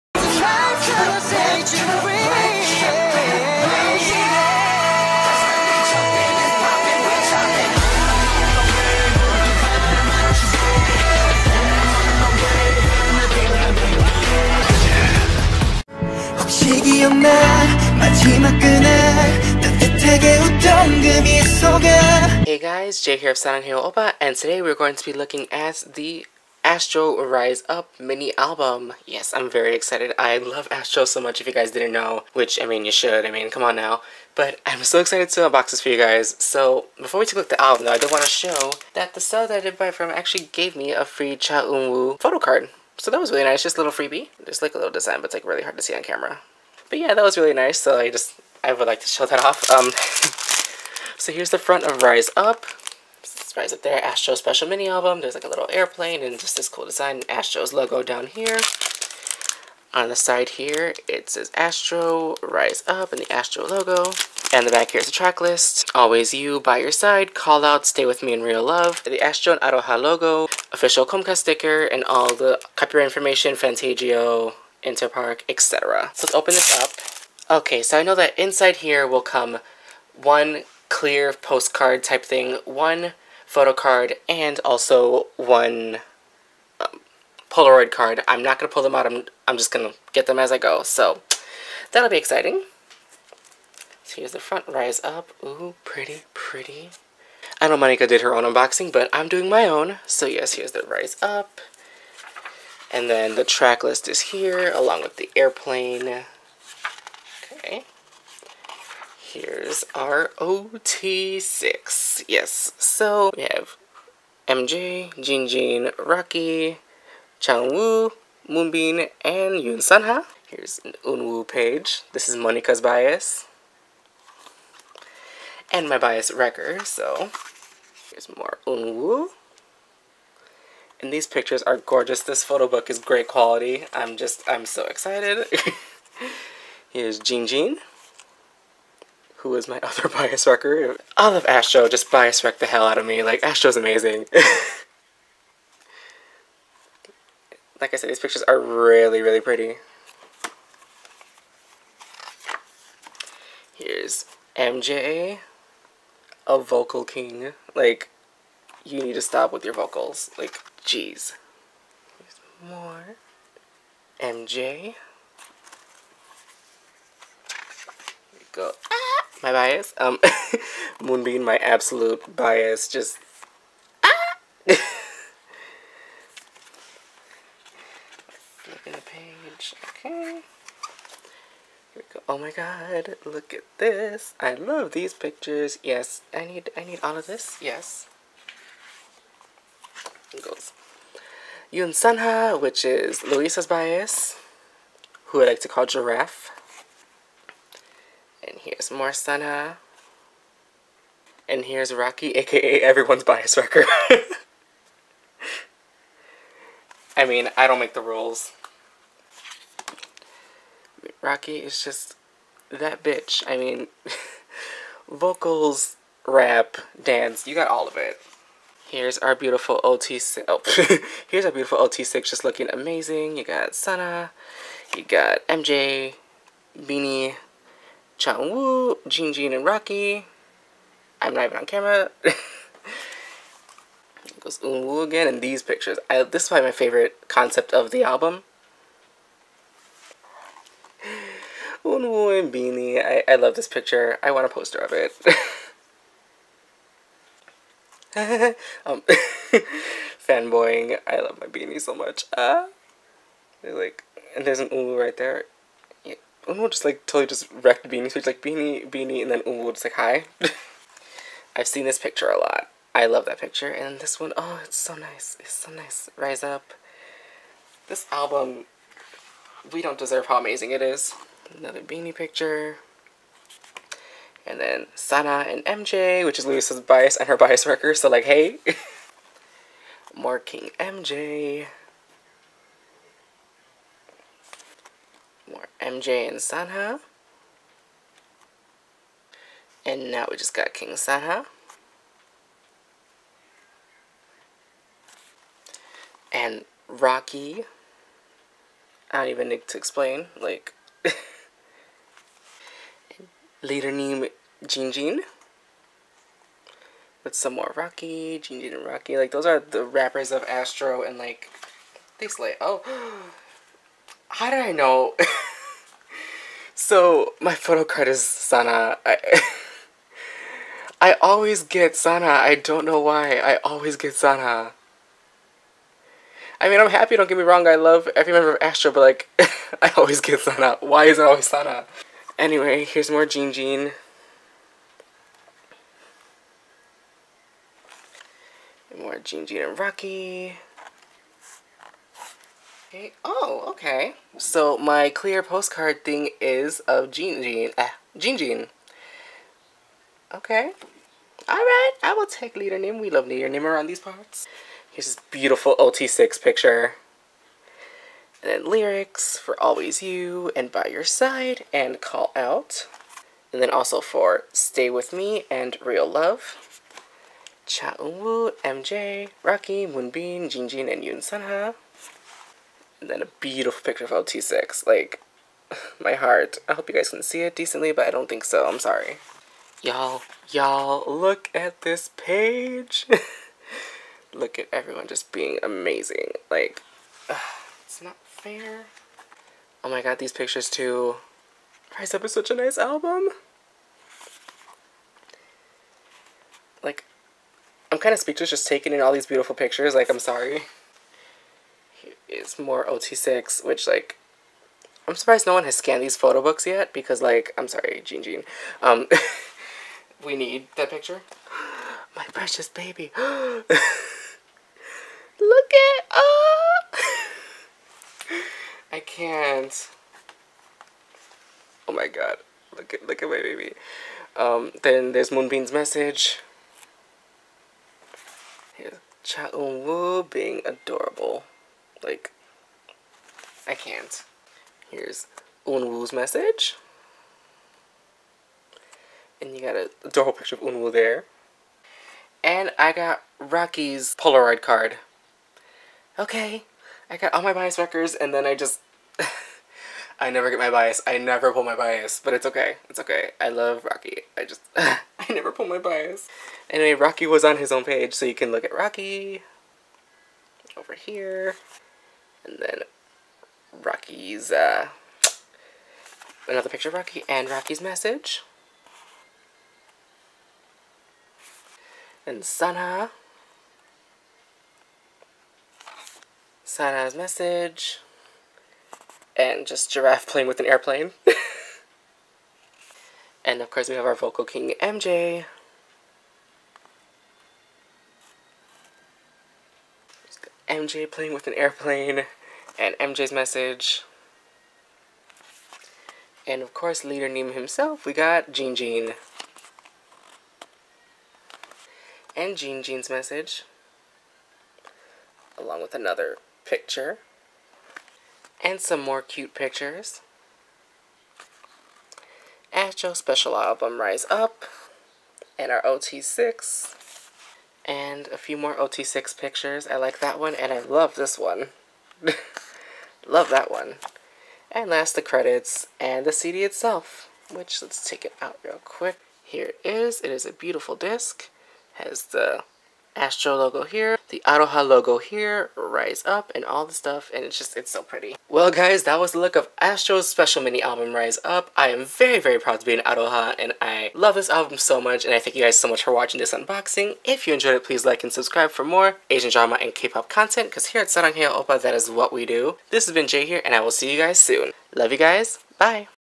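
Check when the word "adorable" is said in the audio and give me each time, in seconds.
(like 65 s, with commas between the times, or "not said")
430 s, 440 s.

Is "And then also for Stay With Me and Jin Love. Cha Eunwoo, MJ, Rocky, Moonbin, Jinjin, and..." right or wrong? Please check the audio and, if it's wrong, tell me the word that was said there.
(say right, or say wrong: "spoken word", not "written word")
wrong: "Real", not "Jin".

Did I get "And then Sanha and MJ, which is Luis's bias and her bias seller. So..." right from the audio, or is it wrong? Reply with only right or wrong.
wrong.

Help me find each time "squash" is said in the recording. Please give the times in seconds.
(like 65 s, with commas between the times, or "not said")
not said.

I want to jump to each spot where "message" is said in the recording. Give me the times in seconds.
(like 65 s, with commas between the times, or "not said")
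425 s, 436 s, 467 s, 477 s, 493 s, 503 s.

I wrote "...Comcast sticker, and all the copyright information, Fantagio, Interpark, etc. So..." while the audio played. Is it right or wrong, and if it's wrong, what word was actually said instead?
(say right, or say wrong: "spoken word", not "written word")
right.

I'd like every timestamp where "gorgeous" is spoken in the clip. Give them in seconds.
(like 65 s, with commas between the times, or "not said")
131 s.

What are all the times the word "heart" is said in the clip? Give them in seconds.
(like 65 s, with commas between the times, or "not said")
376 s.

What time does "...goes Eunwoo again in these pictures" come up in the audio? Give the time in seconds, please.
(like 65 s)
234 s.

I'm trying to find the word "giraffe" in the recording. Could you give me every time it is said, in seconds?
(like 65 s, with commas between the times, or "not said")
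195 s, 479 s.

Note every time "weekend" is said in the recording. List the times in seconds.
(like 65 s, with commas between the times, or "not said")
not said.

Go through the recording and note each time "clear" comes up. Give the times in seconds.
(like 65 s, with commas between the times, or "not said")
80 s, 345 s.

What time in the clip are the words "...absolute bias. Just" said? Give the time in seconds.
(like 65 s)
171 s.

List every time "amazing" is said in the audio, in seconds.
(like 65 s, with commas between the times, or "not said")
143 s, 222 s, 270 s, 385 s.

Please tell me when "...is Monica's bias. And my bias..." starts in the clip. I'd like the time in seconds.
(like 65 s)
122 s.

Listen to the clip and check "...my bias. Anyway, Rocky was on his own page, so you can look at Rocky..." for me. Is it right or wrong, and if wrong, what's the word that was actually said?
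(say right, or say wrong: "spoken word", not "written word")
right.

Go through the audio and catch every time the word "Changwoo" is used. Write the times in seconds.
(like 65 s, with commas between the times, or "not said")
117 s, 228 s.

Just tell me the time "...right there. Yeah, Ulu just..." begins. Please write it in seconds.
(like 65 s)
254 s.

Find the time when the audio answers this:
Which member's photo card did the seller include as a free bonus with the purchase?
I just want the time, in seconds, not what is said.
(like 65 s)
41 s.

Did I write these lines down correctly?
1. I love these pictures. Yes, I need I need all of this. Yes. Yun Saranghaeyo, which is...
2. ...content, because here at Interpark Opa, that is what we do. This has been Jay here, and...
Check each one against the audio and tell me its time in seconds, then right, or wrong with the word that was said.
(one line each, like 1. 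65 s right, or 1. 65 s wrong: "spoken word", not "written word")
1. 184 s wrong: "Sanha", not "Saranghaeyo"
2. 550 s wrong: "Sarang", not "Interpark".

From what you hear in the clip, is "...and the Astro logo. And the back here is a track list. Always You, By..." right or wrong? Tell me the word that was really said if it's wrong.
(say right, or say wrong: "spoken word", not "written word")
right.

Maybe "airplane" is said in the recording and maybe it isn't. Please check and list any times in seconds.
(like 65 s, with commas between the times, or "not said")
55 s, 105 s, 480 s, 491 s.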